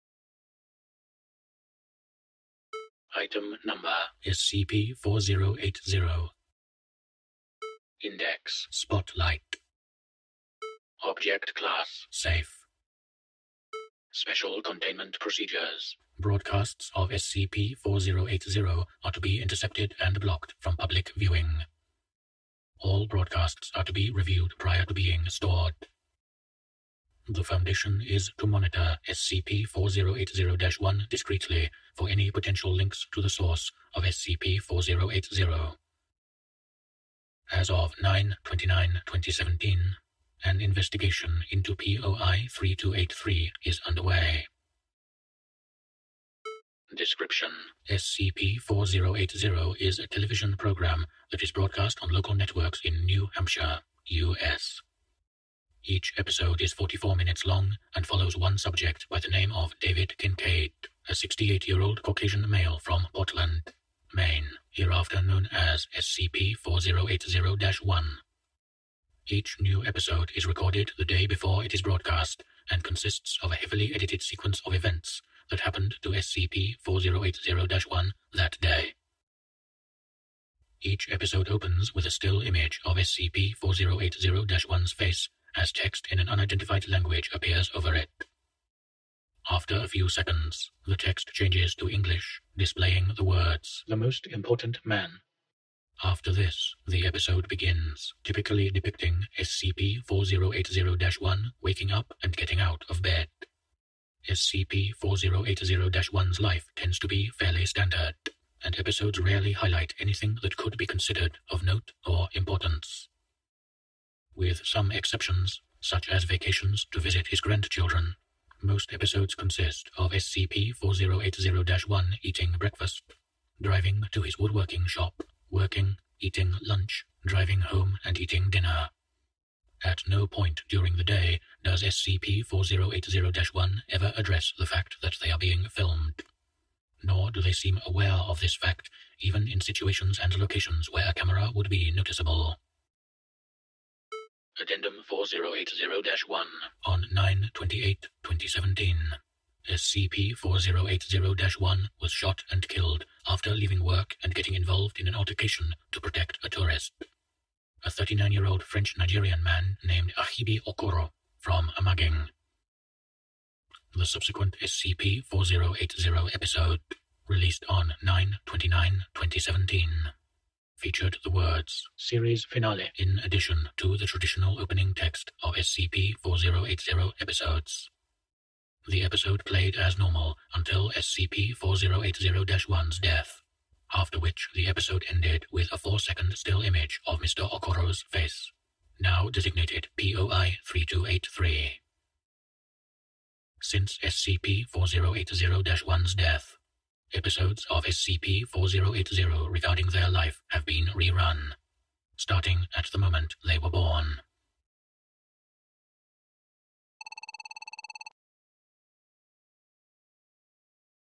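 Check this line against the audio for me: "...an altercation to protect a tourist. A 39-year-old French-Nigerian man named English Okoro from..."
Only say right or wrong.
wrong.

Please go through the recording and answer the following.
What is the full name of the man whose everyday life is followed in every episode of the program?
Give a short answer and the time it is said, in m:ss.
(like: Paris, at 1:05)
David Kincaid, at 0:59.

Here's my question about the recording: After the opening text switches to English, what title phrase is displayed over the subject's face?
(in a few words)
The Most Important Man.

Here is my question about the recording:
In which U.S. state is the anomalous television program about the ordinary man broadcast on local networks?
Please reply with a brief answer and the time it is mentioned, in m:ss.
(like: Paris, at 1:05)
New Hampshire, at 0:53.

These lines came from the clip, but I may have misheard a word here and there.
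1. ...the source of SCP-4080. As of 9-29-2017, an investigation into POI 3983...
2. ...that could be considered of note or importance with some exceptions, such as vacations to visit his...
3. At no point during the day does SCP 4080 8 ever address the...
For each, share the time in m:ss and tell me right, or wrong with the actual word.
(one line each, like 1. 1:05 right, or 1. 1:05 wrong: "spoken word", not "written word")
1. 0:33 wrong: "3283", not "3983"
2. 1:50 right
3. 2:09 wrong: "1", not "8".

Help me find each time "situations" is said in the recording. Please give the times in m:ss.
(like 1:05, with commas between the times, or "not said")
2:19.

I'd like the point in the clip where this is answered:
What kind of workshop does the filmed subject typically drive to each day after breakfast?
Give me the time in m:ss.
2:04.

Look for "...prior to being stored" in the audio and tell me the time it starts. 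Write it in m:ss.
0:24.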